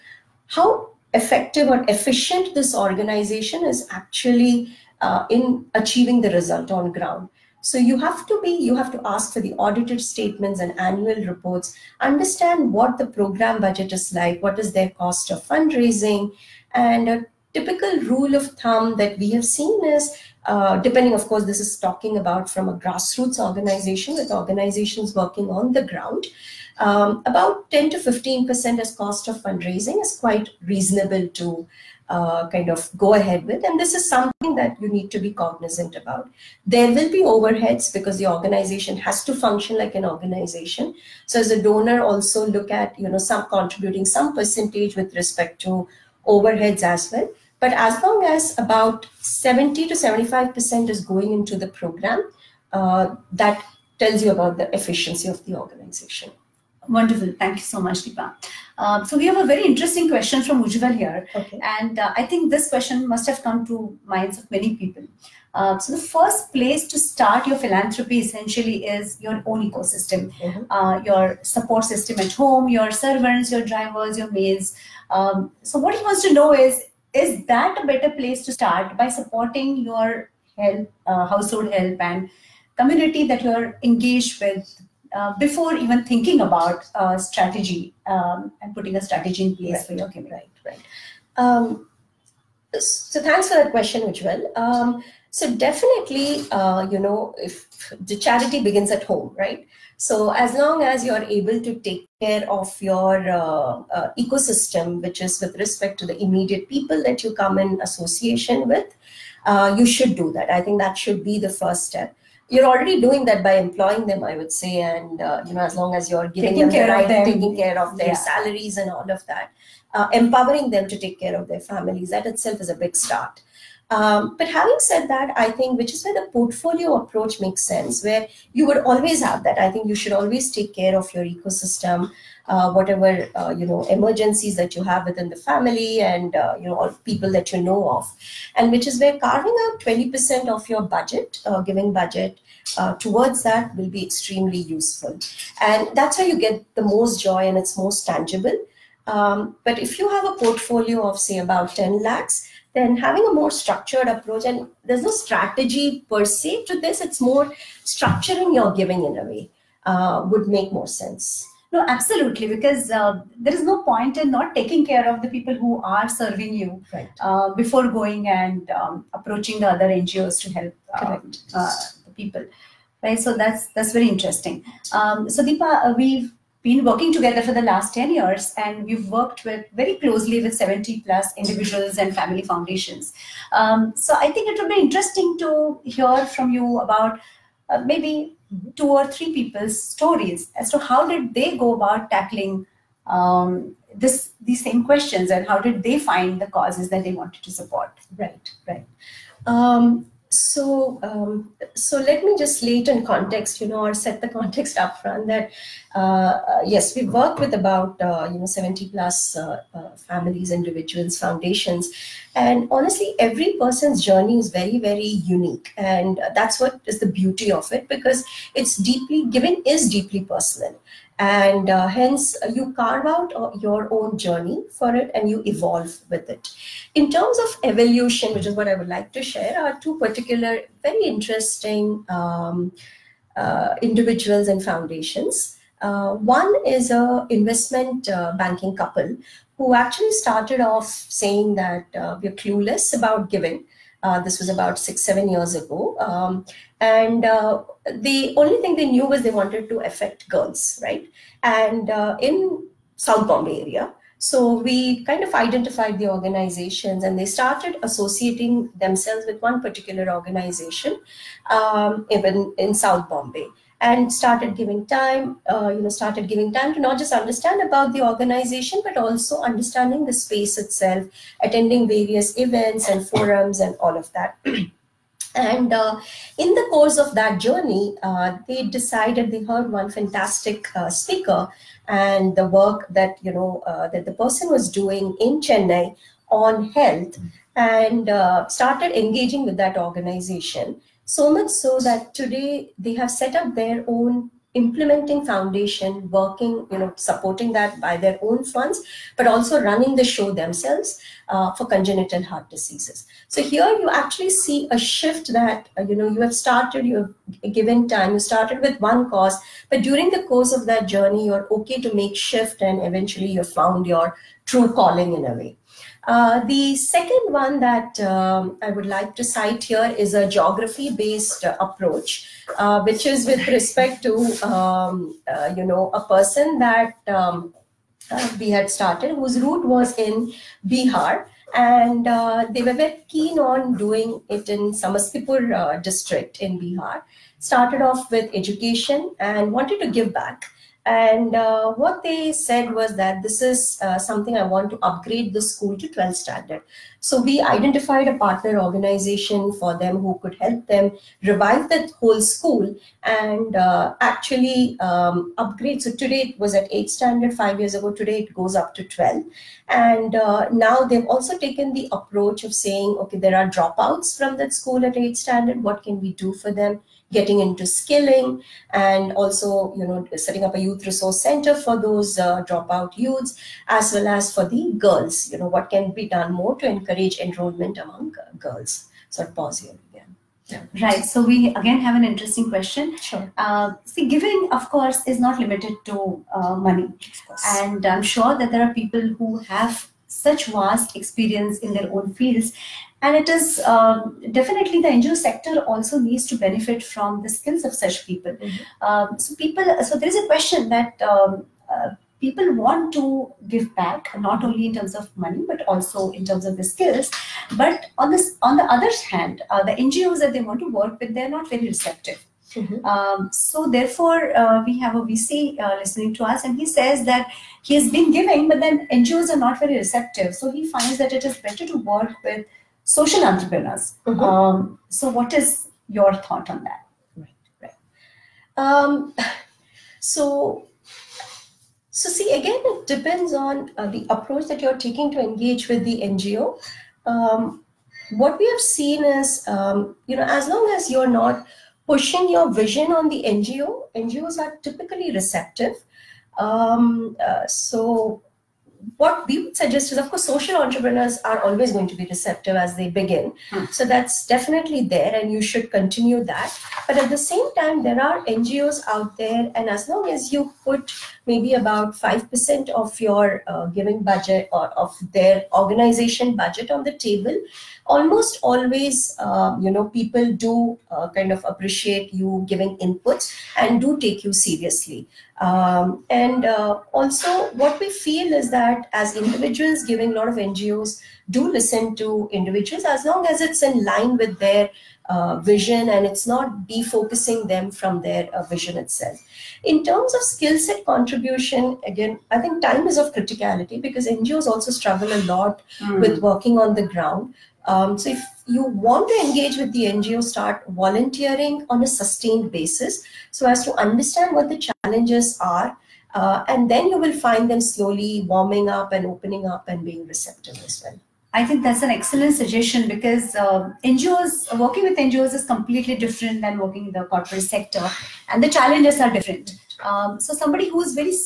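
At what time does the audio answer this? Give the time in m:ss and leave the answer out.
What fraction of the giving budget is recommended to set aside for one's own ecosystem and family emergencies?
2:19.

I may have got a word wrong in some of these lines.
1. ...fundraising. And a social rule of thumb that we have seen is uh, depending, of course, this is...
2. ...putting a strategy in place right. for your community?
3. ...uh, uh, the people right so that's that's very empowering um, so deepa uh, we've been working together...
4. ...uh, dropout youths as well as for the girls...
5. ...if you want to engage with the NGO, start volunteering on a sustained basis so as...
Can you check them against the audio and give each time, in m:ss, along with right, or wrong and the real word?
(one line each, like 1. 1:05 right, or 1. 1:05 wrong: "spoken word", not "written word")
1. 0:15 wrong: "typical", not "social"
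2. 1:28 right
3. 2:51 wrong: "interesting", not "empowering"
4. 6:12 right
5. 8:18 right.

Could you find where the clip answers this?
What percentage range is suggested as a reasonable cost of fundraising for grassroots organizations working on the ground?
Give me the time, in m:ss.
0:27.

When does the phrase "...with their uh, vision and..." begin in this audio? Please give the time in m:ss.
8:04.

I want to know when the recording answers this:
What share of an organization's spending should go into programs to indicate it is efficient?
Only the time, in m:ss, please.
0:49.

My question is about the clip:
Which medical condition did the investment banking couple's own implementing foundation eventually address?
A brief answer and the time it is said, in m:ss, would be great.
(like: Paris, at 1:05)
Congenital heart diseases, at 5:01.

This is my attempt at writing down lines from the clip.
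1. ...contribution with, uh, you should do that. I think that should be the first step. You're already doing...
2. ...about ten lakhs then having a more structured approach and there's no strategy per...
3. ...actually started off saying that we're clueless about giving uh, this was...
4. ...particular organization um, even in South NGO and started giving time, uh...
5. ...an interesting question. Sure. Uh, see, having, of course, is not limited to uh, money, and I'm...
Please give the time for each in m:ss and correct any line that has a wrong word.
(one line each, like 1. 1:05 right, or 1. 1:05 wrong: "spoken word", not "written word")
1. 1:47 wrong: "association", not "contribution"
2. 2:31 right
3. 3:59 right
4. 4:19 wrong: "Bombay", not "NGO"
5. 6:21 wrong: "giving", not "having".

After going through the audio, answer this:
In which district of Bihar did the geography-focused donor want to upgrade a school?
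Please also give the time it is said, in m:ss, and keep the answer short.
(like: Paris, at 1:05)
Samastipur, at 5:34.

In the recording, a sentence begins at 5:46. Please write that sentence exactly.
So we identified a partner organization for them who could help them revive that whole school and uh, actually um, upgrade.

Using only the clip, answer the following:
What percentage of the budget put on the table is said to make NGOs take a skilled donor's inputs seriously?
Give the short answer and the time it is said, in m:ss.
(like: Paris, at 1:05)
5%, at 7:41.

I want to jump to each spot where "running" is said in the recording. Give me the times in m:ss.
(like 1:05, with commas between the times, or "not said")
4:59.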